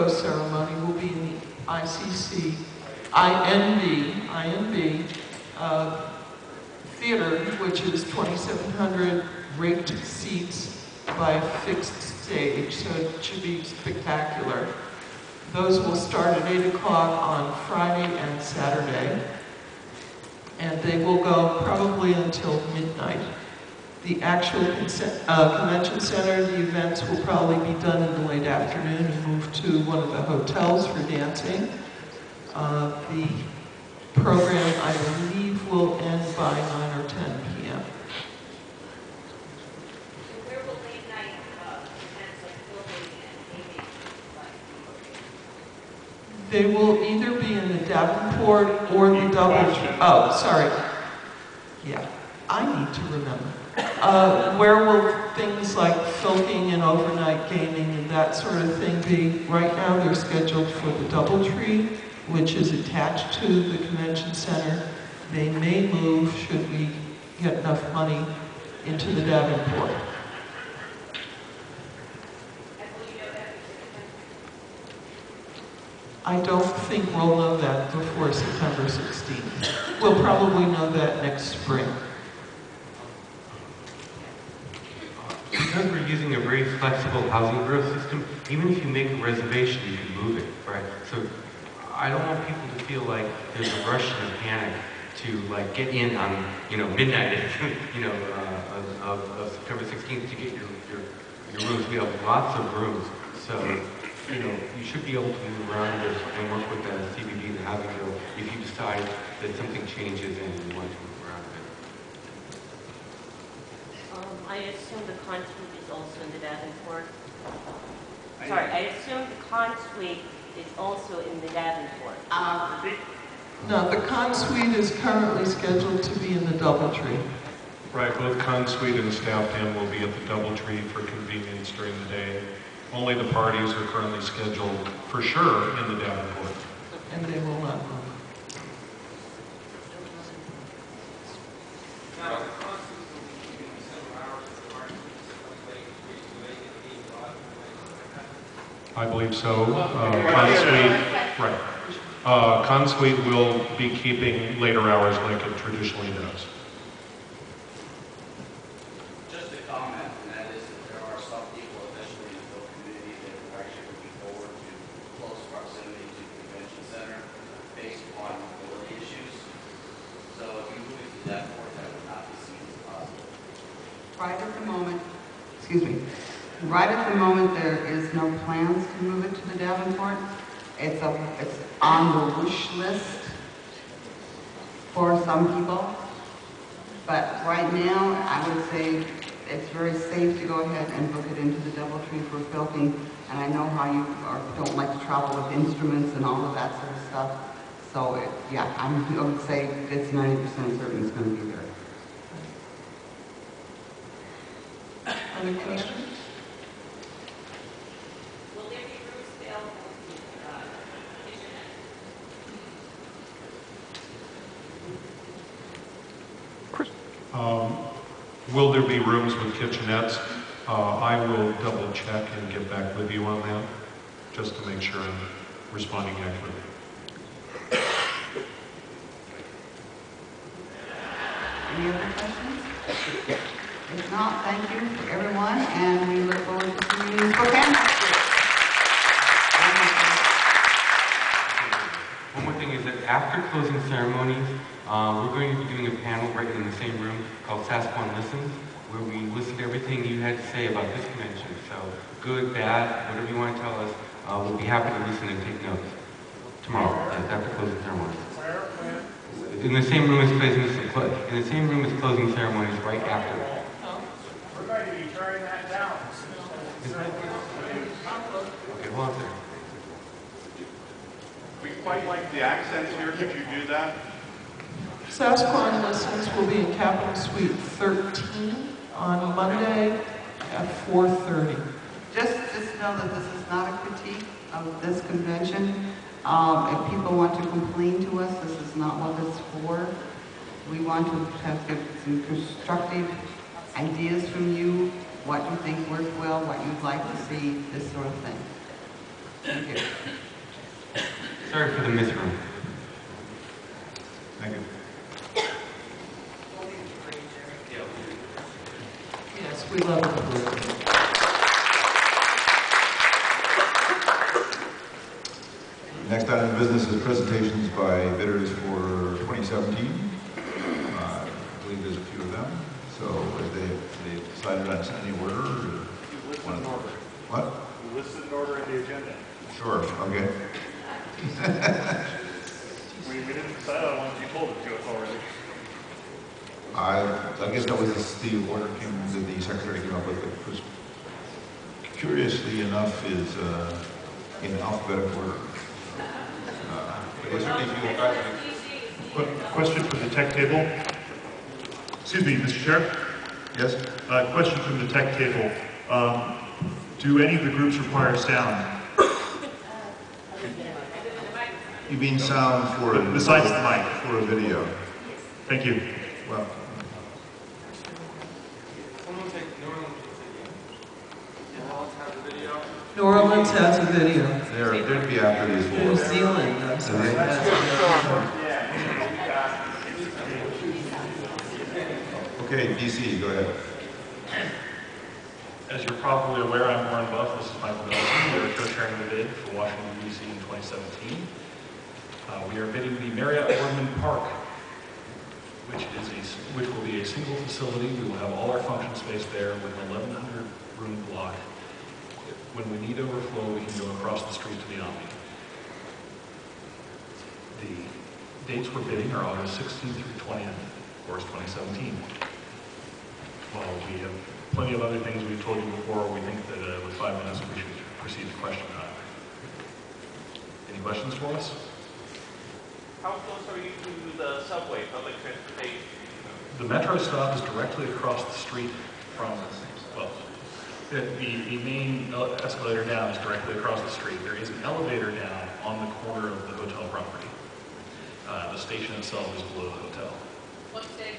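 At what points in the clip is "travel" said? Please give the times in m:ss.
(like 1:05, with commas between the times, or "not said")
3:15.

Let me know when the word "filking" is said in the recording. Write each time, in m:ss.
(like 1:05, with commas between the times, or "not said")
0:56, 3:12.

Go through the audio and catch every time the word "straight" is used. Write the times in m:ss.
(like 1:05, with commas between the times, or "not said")
not said.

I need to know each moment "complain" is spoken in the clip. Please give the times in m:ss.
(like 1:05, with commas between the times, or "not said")
4:47.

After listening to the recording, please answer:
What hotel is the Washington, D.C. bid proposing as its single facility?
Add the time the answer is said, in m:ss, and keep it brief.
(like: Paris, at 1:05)
Marriott Wardman Park, at 6:33.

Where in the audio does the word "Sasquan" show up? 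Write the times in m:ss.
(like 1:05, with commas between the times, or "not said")
4:07, 4:35.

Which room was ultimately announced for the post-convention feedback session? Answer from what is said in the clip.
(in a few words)
Capitol Suite 13.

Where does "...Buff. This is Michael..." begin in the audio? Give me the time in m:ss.
6:27.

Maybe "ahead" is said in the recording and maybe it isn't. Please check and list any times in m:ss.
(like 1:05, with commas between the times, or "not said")
3:10, 6:23.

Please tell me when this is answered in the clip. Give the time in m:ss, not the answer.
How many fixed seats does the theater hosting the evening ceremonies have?
0:08.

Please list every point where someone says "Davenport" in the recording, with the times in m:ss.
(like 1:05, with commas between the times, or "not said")
0:47, 1:09, 1:56, 2:01, 2:16, 2:59.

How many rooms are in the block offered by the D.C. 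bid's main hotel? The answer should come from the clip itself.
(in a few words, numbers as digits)
1,100.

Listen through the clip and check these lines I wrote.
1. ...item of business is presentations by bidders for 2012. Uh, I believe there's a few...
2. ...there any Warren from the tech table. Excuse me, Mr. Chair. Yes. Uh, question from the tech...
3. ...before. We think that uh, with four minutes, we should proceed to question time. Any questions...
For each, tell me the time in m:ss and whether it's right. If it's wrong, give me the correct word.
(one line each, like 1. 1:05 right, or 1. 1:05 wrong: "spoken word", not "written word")
1. 5:16 wrong: "2017", not "2012"
2. 5:47 wrong: "Question", not "Warren"
3. 6:55 wrong: "five", not "four".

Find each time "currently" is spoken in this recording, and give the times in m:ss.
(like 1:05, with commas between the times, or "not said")
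2:04, 2:13.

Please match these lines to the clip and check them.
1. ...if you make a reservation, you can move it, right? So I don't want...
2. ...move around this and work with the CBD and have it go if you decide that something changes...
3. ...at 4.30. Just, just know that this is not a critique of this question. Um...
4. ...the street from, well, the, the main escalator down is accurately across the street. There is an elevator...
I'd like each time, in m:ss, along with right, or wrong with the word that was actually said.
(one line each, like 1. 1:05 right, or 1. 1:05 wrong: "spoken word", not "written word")
1. 1:28 right
2. 1:45 right
3. 4:40 wrong: "convention", not "question"
4. 7:08 wrong: "directly", not "accurately".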